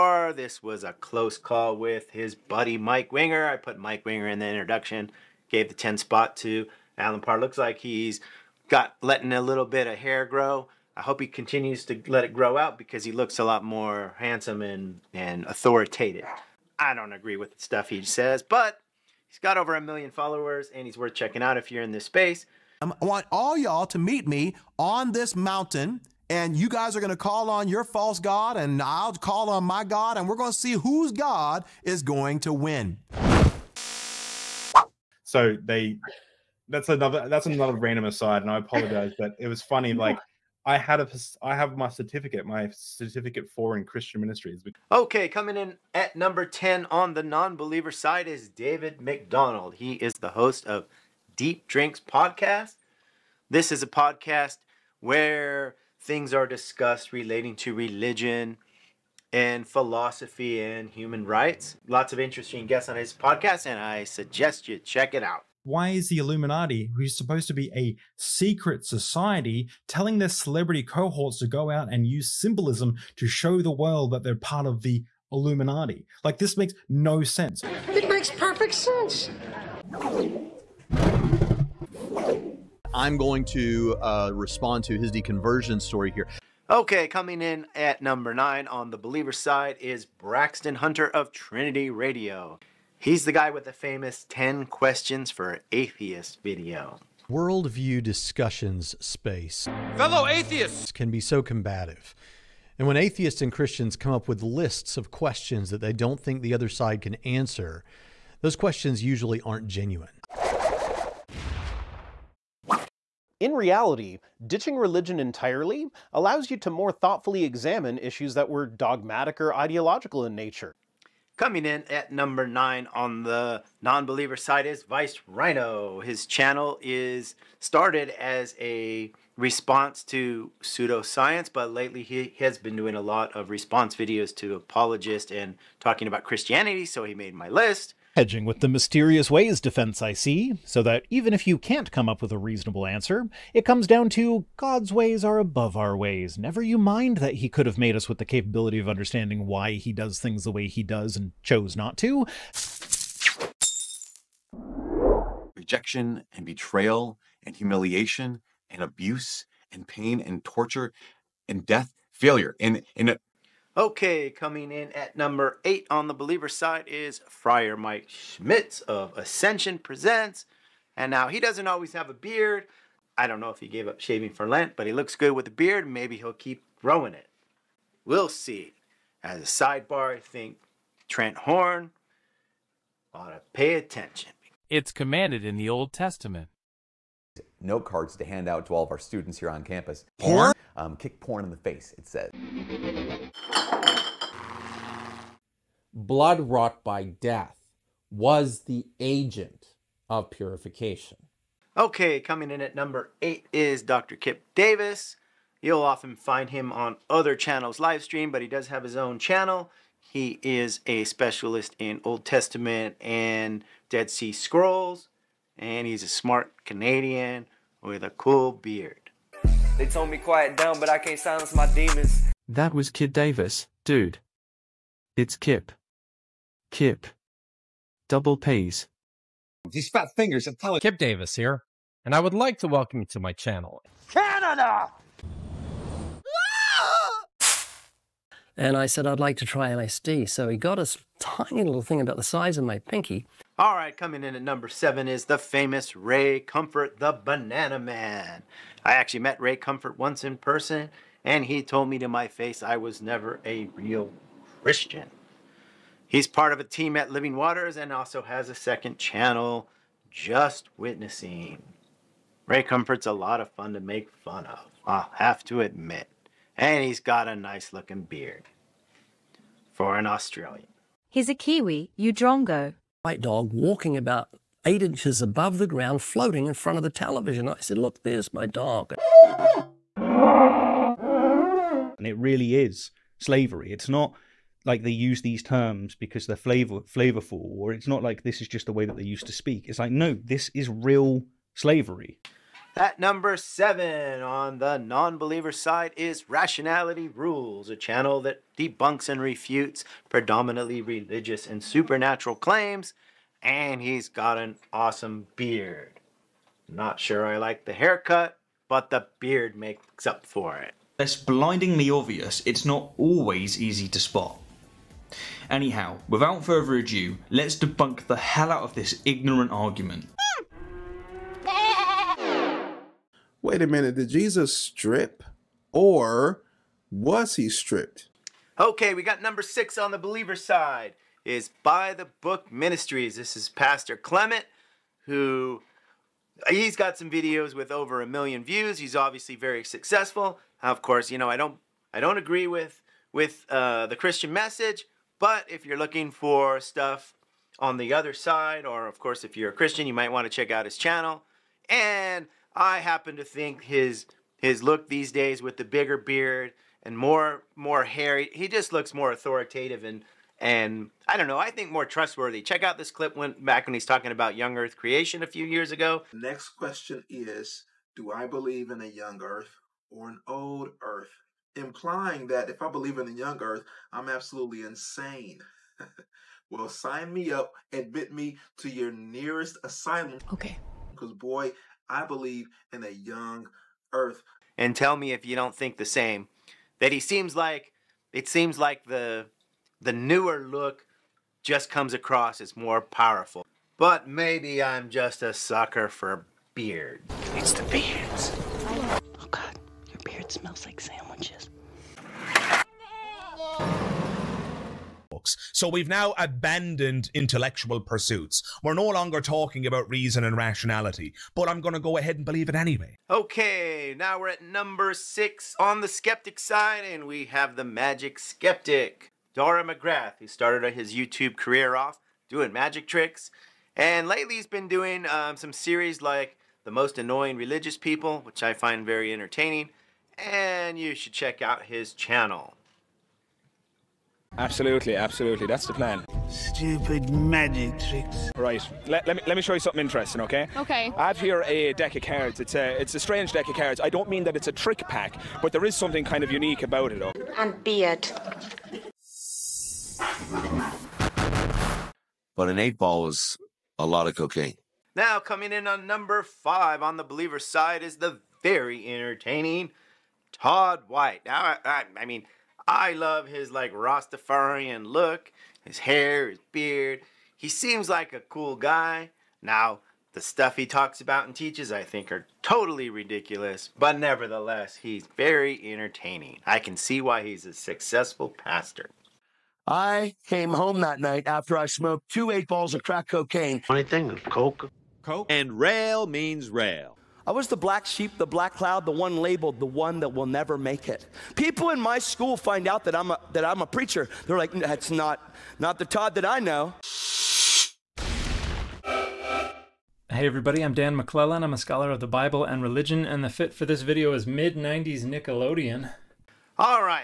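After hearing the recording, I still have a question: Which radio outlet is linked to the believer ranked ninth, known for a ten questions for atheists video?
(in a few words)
Trinity Radio.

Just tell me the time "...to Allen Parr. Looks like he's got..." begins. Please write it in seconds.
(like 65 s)
6 s.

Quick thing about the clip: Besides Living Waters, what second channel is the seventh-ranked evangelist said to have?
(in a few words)
Just Witnessing.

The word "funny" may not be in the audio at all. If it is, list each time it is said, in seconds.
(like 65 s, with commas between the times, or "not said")
39 s, 483 s.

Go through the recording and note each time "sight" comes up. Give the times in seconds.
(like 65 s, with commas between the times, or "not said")
not said.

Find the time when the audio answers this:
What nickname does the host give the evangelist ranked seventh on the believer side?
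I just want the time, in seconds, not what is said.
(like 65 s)
246 s.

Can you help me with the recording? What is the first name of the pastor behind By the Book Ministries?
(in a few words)
Clement.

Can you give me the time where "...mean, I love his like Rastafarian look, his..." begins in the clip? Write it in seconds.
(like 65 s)
462 s.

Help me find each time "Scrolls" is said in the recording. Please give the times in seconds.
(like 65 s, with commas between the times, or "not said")
214 s.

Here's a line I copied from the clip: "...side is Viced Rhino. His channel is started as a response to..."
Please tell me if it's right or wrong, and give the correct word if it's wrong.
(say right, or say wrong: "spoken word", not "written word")
right.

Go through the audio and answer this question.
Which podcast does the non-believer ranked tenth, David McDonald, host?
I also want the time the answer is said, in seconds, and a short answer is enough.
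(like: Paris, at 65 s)
Deep Drinks, at 51 s.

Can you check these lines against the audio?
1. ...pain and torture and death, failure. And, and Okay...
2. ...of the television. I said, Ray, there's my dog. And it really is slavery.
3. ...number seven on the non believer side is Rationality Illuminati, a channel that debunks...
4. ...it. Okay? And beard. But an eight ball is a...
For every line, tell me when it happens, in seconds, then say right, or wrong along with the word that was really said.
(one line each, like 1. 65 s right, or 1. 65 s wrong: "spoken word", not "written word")
1. 159 s right
2. 276 s wrong: "Look", not "Ray"
3. 292 s wrong: "Rules", not "Illuminati"
4. 446 s right.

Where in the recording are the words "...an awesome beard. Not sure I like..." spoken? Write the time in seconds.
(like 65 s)
304 s.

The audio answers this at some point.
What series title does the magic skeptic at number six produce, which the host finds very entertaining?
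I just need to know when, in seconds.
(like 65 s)
426 s.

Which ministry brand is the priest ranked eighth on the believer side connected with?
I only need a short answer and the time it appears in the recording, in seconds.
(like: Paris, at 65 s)
Ascension Presents, at 169 s.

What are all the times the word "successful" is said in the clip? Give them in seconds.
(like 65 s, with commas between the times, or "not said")
339 s, 477 s.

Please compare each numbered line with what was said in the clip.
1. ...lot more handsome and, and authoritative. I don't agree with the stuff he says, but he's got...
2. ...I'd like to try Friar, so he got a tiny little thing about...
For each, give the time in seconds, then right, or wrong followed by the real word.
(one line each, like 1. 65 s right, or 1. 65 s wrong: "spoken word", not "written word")
1. 13 s right
2. 239 s wrong: "LSD", not "Friar".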